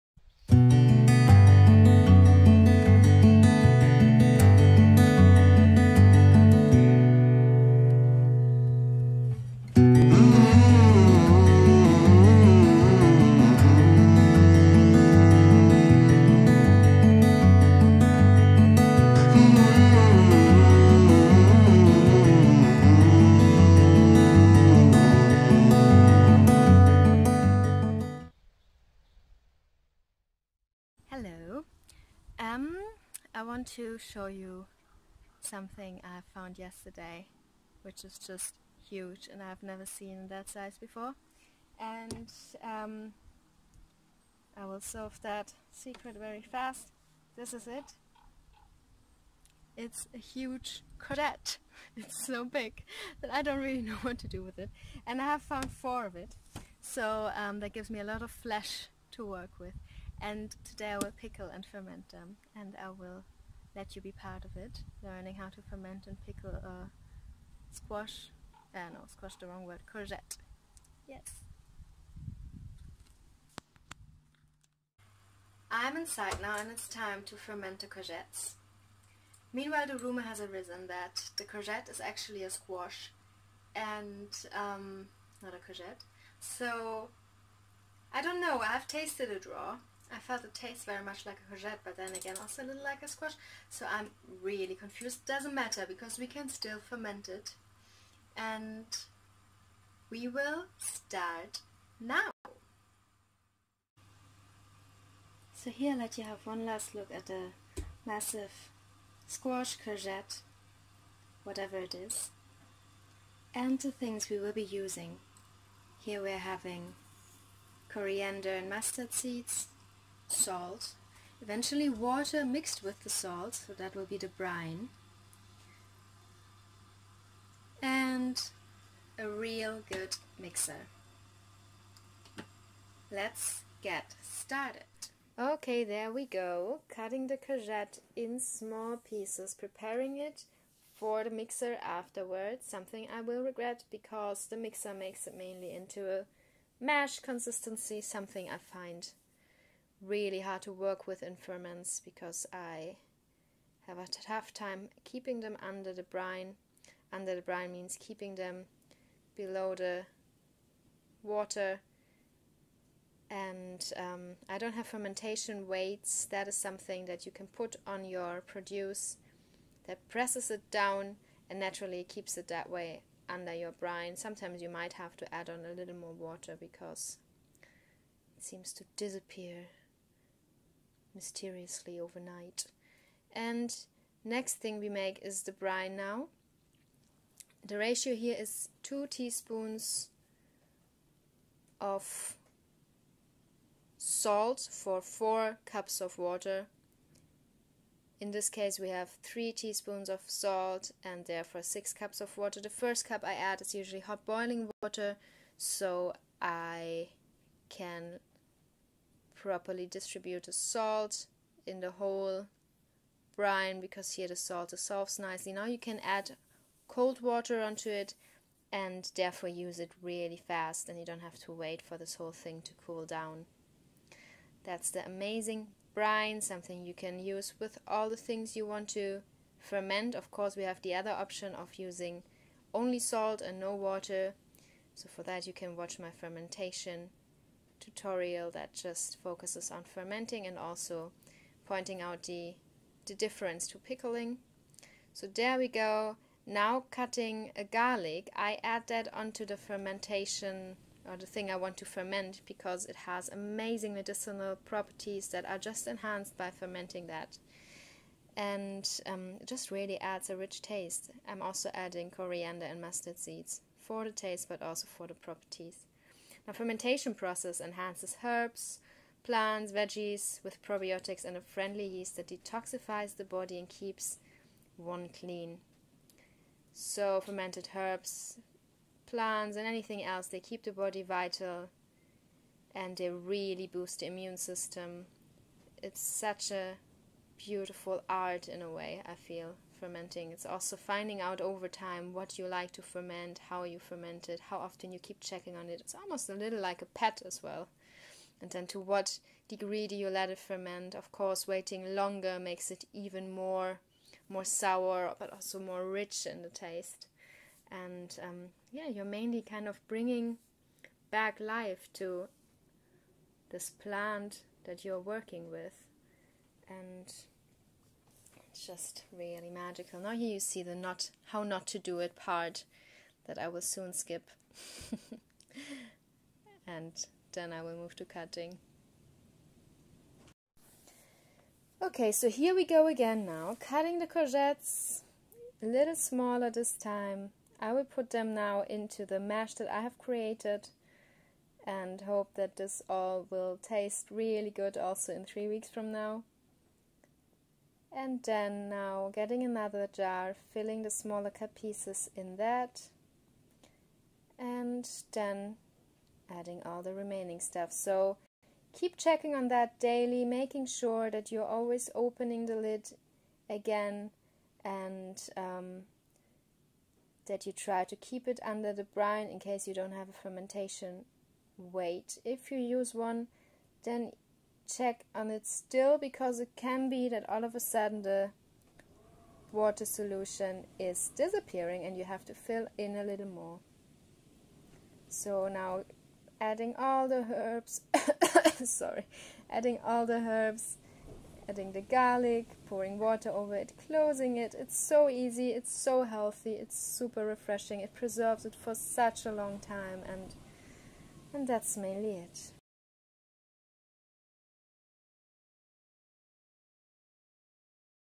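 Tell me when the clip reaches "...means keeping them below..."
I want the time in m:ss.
2:37.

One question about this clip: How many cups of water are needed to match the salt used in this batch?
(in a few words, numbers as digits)
6.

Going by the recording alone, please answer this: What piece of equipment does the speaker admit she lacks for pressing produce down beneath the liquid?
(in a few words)
Fermentation weights.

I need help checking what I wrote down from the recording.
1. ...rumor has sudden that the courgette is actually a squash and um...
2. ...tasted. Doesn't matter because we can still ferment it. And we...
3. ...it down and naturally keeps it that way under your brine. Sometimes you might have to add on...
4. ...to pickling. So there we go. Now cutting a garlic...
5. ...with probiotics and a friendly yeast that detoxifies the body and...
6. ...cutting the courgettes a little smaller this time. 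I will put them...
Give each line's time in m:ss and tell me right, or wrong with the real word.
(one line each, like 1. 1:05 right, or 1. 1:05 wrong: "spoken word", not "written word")
1. 1:19 wrong: "arisen", not "sudden"
2. 1:34 wrong: "confused", not "tasted"
3. 2:50 right
4. 4:03 right
5. 4:30 right
6. 5:33 right.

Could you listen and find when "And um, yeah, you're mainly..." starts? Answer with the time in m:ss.
5:07.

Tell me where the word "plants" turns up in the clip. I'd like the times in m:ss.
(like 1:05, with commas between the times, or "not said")
4:29, 4:39, 5:13.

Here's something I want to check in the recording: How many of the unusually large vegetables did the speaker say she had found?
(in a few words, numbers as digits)
4.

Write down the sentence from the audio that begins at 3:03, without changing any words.
And next thing we make is the brine now.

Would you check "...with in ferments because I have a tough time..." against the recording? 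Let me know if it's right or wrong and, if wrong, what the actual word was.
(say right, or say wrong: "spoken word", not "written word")
right.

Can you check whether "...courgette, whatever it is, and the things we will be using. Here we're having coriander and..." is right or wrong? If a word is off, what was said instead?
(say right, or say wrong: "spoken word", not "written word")
right.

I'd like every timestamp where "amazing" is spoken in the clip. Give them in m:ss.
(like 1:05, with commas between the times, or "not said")
3:45, 4:13.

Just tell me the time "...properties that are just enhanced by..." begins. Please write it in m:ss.
4:14.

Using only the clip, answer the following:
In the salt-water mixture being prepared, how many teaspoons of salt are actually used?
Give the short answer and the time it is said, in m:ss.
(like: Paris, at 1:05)
3, at 3:19.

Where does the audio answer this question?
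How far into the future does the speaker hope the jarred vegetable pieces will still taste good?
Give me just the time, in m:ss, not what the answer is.
5:45.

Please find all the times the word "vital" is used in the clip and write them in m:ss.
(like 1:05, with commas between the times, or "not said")
4:41.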